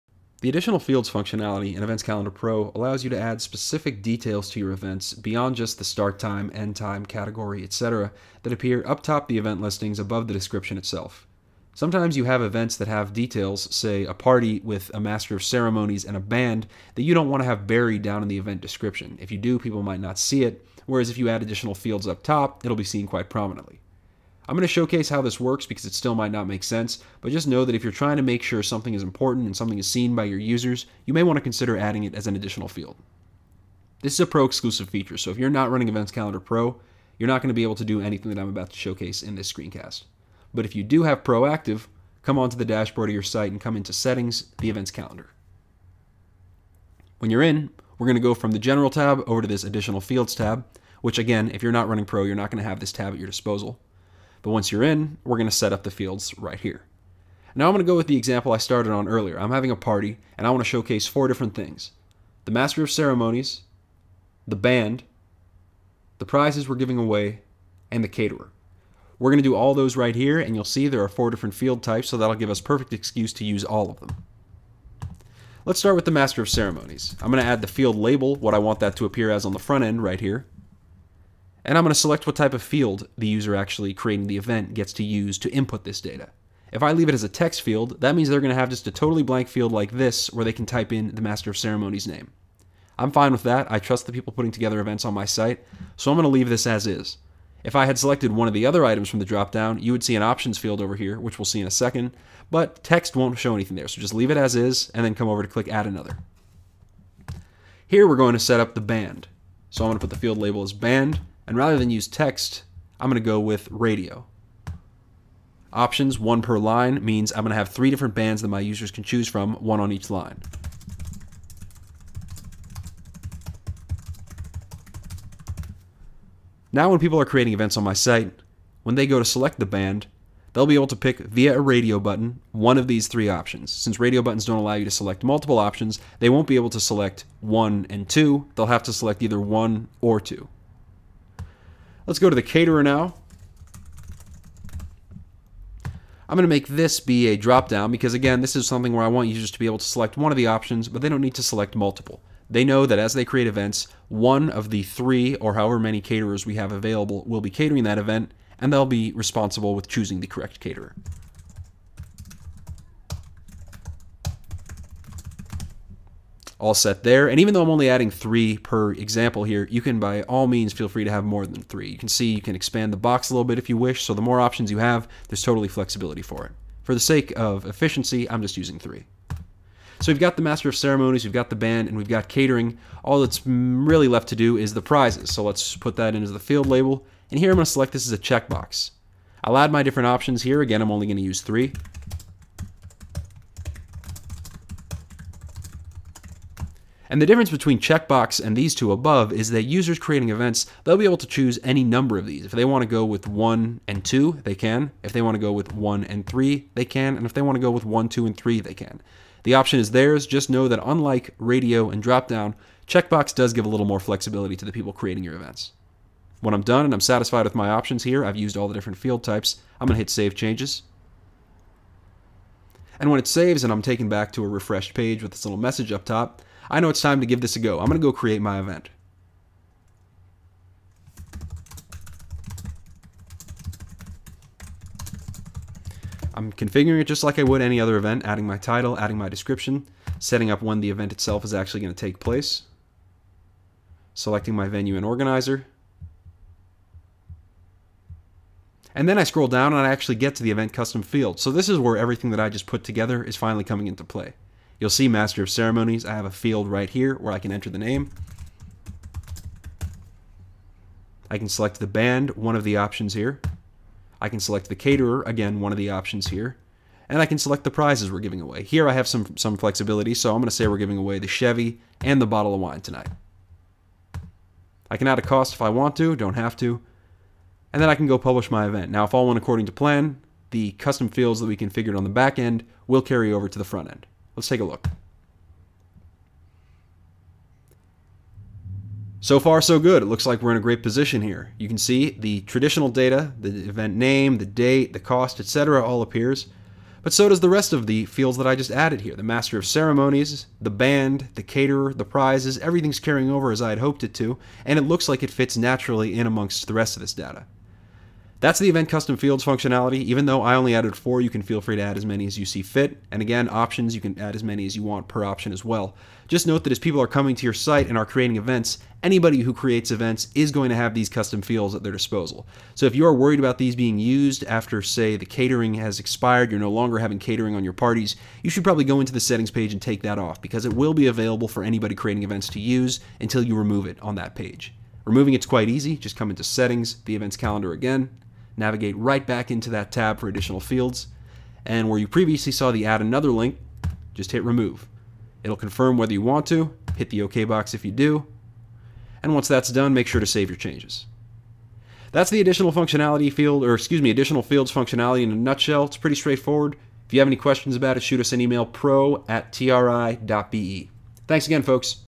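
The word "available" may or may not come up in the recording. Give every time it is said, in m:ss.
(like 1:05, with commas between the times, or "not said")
2:36, 5:31.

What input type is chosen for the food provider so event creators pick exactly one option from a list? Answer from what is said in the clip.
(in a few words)
drop down.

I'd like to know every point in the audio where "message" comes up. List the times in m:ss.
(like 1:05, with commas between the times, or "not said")
3:45.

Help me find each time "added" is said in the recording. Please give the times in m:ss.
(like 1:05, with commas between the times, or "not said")
4:58, 5:10.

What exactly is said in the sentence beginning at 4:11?
So this is where everything that I just put together is finally coming into play.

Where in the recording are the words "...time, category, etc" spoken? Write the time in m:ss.
0:06.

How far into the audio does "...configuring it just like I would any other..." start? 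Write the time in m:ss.
3:56.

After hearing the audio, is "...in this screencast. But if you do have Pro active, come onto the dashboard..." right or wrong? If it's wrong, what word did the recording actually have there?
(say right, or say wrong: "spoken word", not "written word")
right.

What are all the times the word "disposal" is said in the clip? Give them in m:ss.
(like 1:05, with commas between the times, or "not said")
0:53, 5:21.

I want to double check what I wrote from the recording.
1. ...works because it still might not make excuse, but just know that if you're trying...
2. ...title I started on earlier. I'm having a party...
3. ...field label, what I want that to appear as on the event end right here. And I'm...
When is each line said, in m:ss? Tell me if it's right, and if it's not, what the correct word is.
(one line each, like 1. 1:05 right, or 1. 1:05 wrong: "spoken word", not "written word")
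1. 0:25 wrong: "sense", not "excuse"
2. 0:58 wrong: "example", not "title"
3. 1:17 wrong: "front", not "event".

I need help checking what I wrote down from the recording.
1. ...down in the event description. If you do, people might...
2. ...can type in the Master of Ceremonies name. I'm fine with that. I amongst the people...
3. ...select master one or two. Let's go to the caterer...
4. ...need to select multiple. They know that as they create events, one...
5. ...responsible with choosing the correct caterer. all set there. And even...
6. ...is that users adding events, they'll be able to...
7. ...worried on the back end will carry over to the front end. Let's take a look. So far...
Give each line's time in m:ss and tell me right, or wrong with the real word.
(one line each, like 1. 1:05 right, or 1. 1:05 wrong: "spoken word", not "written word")
1. 0:18 right
2. 1:30 wrong: "trust", not "amongst"
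3. 2:18 wrong: "either", not "master"
4. 2:31 right
5. 2:39 right
6. 3:19 wrong: "creating", not "adding"
7. 4:41 wrong: "configured", not "worried".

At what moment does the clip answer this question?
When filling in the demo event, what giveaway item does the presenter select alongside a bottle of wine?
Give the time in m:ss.
4:31.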